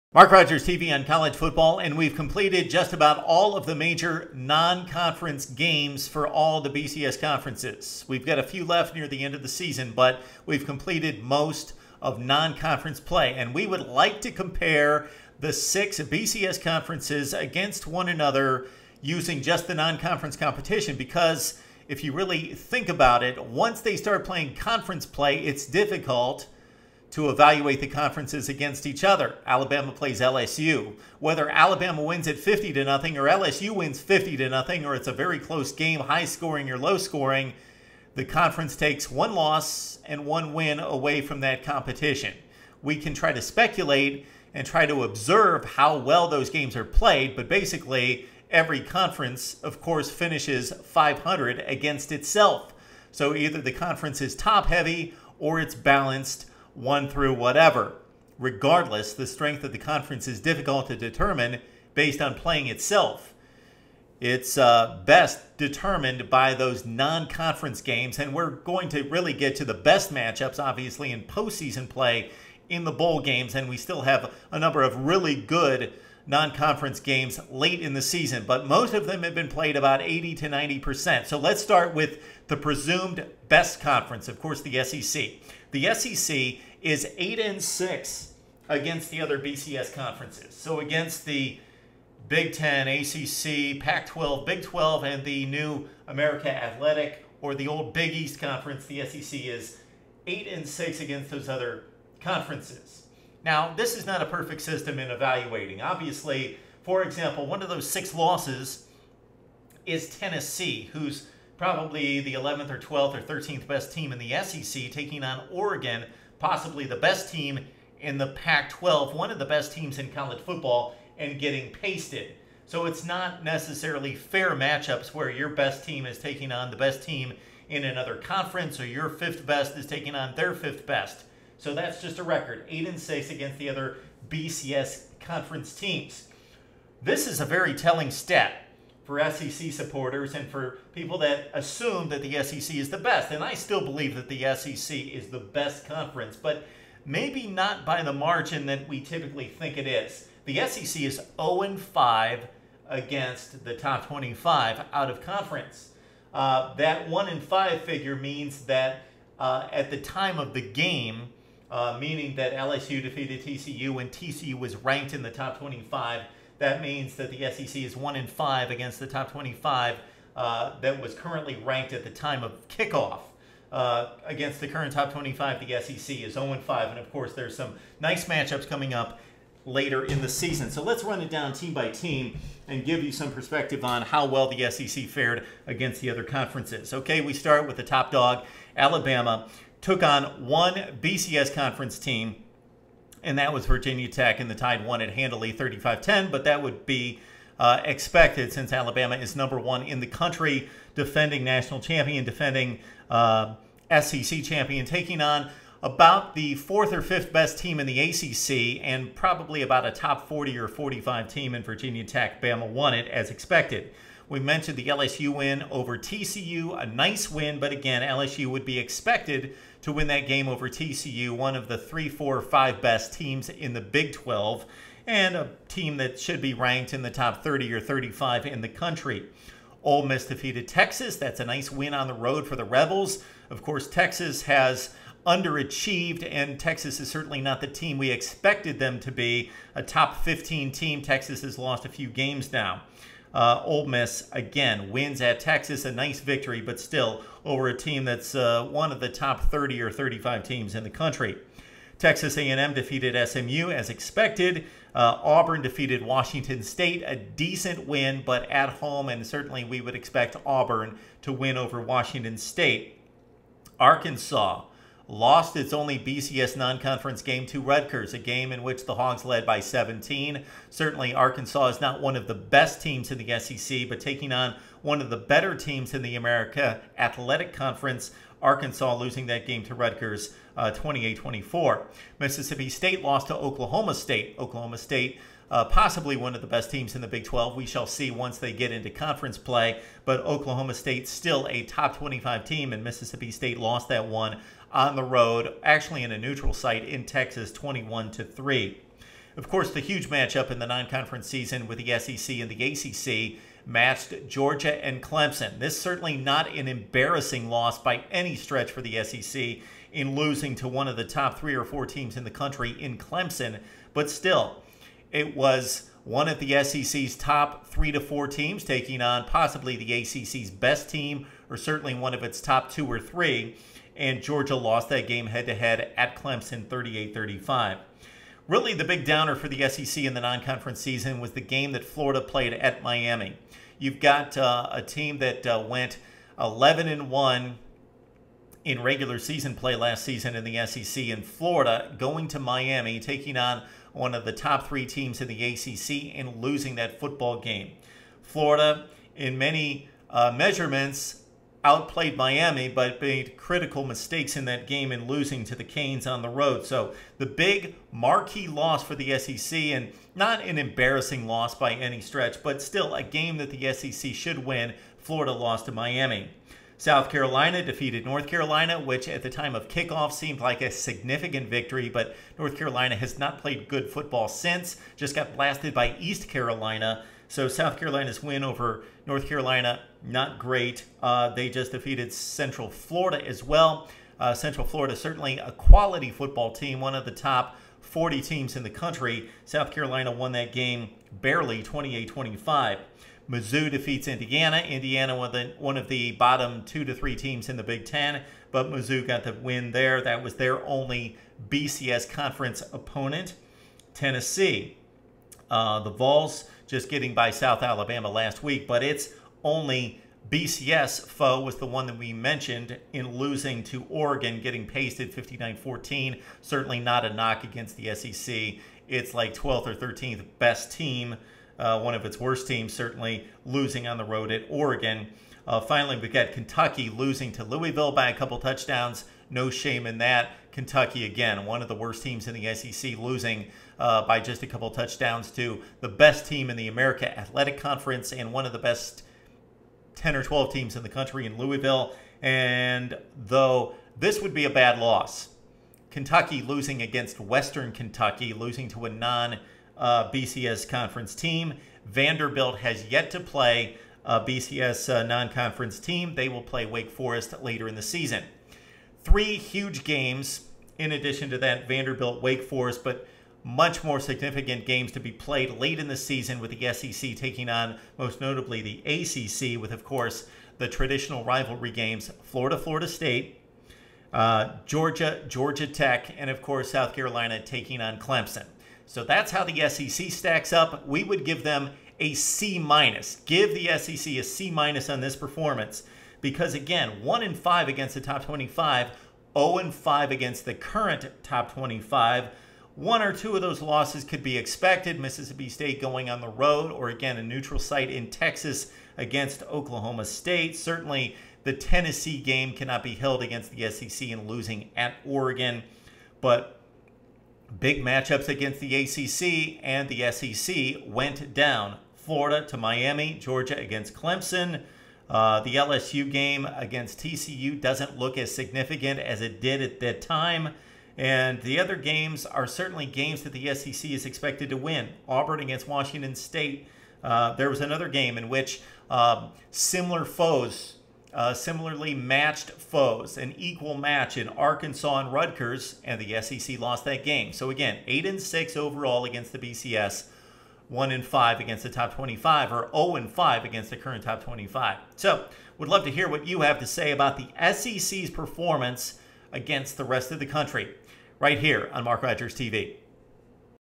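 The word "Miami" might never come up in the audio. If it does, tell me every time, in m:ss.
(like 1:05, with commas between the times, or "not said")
5:32, 5:42, 5:52, 6:05, 8:32.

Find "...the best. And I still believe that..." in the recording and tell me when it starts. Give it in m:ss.
2:22.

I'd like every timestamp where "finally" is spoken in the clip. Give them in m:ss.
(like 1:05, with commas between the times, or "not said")
7:05.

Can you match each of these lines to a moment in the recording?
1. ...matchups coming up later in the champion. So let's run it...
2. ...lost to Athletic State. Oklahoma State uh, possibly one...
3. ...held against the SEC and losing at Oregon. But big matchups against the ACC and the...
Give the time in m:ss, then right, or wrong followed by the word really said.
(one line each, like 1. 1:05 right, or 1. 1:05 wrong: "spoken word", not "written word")
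1. 2:58 wrong: "season", not "champion"
2. 4:43 wrong: "Oklahoma", not "Athletic"
3. 8:22 right.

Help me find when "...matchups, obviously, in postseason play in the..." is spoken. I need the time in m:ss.
1:10.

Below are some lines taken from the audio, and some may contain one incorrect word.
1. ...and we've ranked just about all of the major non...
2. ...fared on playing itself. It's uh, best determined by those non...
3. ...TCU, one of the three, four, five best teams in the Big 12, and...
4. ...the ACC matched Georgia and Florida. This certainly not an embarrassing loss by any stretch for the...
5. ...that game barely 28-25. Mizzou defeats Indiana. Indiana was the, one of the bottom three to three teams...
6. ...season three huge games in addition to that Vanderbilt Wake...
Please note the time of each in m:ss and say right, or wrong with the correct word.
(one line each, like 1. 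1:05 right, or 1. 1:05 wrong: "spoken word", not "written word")
1. 0:01 wrong: "completed", not "ranked"
2. 1:01 wrong: "based", not "fared"
3. 3:40 right
4. 5:02 wrong: "Clemson", not "Florida"
5. 6:30 wrong: "two", not "three"
6. 7:37 right.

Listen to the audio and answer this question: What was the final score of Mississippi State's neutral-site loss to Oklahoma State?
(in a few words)
21 to 3.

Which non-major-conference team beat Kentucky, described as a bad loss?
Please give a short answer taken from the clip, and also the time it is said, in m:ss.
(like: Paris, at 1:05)
Western Kentucky, at 7:27.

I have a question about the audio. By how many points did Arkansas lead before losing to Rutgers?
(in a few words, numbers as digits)
17.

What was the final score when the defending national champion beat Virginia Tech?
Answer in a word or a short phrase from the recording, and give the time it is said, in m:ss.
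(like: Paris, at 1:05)
35-10, at 3:15.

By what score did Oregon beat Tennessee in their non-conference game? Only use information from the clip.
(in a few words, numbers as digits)
59-14.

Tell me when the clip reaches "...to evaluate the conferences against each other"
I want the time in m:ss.
0:27.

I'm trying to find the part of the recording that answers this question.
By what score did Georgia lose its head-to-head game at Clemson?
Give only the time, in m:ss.
5:26.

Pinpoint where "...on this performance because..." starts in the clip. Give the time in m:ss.
8:04.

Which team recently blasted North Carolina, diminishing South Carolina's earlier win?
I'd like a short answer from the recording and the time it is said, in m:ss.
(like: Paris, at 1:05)
East Carolina, at 6:15.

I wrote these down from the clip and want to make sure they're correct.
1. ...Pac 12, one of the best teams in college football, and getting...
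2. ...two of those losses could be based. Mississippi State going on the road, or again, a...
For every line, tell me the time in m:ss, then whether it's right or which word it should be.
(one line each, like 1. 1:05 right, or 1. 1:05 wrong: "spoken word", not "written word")
1. 1:58 right
2. 8:13 wrong: "expected", not "based".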